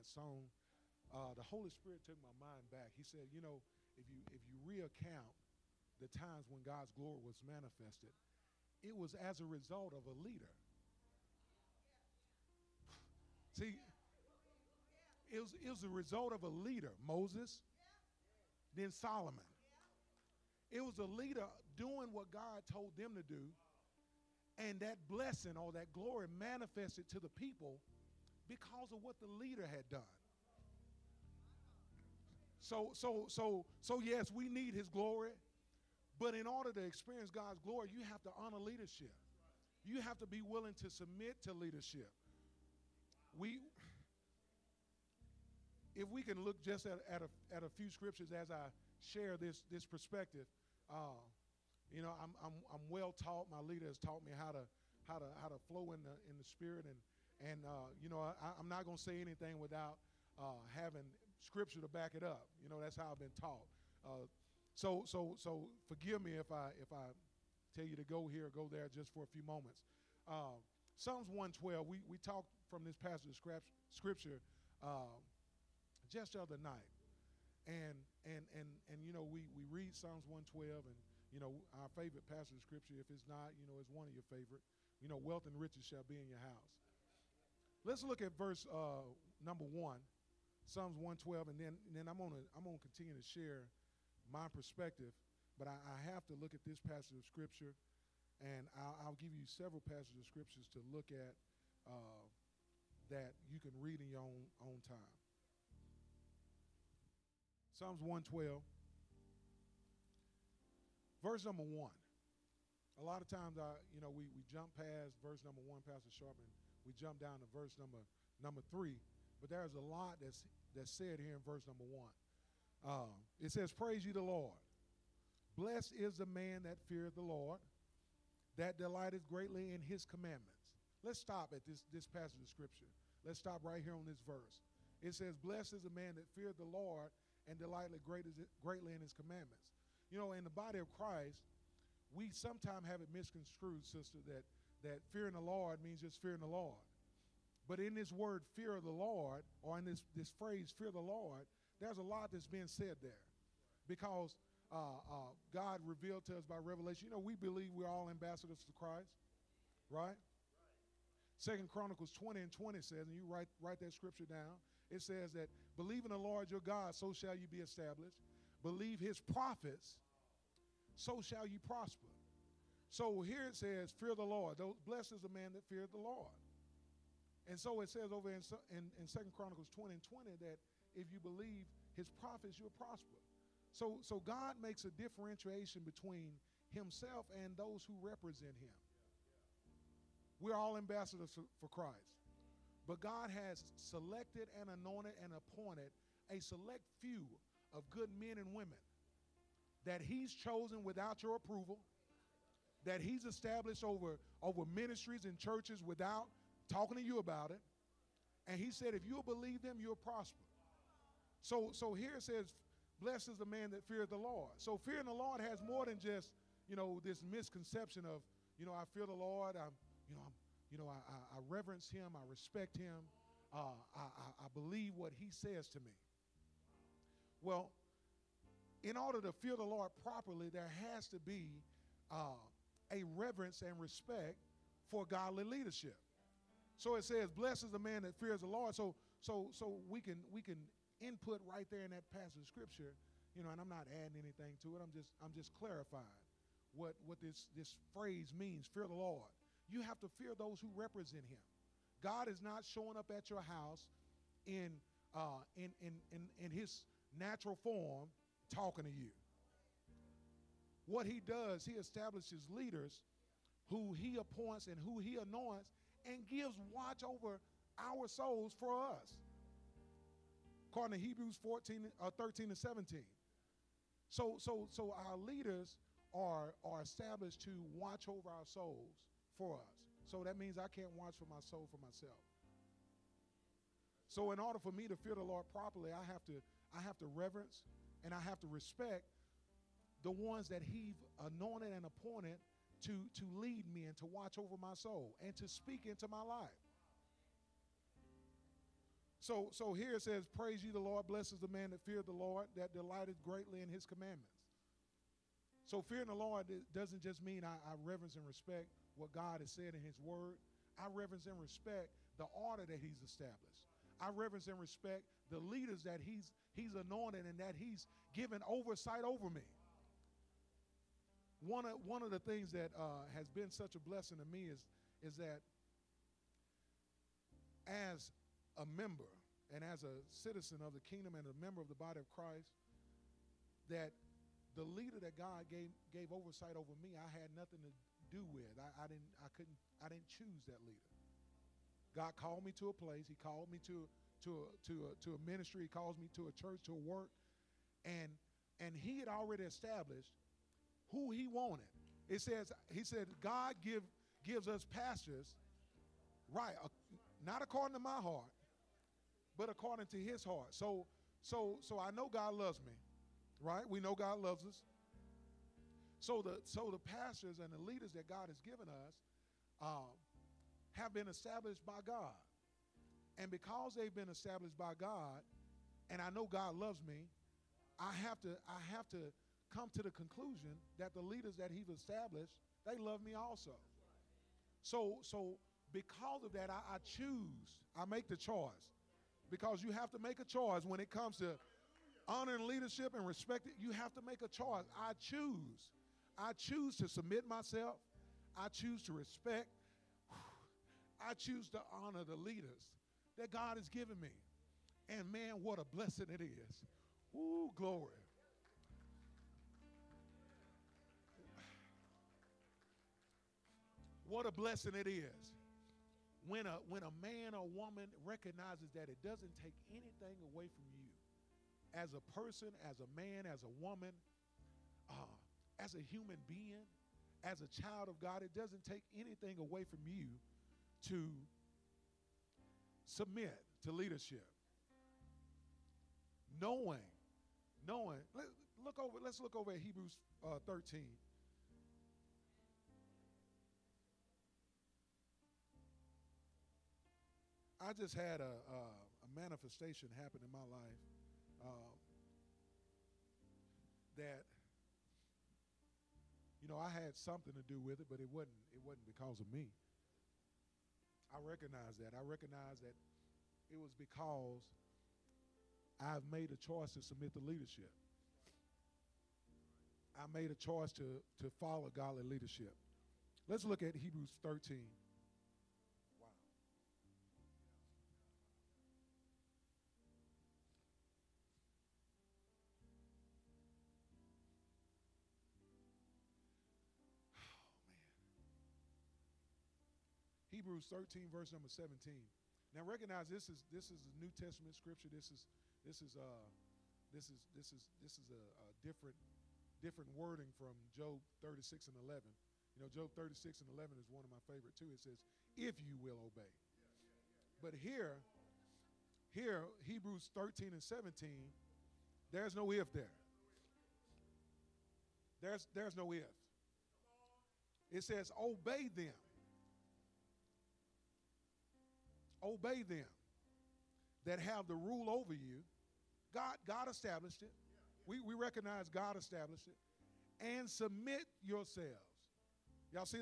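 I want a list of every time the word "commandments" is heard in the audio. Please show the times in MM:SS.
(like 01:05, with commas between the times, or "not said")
02:10, 02:19, 05:03.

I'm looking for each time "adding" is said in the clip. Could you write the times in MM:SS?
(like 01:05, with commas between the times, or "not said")
04:03.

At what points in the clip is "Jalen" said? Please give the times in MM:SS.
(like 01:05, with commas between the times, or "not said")
not said.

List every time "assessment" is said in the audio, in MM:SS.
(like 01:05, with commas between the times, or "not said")
not said.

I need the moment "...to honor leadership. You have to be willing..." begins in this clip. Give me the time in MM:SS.
00:38.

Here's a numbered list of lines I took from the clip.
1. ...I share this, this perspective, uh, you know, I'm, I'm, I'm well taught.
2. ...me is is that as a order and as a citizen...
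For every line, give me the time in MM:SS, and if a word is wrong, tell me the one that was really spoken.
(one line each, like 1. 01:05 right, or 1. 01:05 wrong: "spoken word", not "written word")
1. 00:48 right
2. 05:24 wrong: "member", not "order".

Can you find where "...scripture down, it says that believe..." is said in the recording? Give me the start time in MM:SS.
02:43.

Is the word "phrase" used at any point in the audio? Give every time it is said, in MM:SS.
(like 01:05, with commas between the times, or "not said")
02:30, 04:07.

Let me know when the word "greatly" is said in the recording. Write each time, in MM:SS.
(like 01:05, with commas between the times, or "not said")
02:09, 02:18, 05:03.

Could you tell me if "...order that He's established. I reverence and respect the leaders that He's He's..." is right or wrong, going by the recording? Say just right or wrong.
right.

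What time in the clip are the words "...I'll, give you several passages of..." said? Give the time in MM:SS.
01:38.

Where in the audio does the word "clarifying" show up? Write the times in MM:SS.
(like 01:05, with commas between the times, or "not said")
04:05.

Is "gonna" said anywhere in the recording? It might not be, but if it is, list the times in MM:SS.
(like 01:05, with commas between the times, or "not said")
01:32.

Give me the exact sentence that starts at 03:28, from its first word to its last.
And He said, if you'll believe them, you'll prosper.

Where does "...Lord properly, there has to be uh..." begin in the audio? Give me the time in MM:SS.
03:49.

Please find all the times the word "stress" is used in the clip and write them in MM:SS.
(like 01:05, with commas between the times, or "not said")
not said.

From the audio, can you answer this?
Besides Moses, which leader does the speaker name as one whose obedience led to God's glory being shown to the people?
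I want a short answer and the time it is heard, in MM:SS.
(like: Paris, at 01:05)
Solomon, at 00:18.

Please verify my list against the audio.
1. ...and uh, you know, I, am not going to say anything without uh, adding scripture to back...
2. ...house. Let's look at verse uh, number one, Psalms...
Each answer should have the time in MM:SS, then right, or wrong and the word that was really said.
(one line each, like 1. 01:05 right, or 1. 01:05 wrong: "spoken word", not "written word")
1. 00:57 wrong: "having", not "adding"
2. 01:26 right.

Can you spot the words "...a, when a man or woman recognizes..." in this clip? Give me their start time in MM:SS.
06:56.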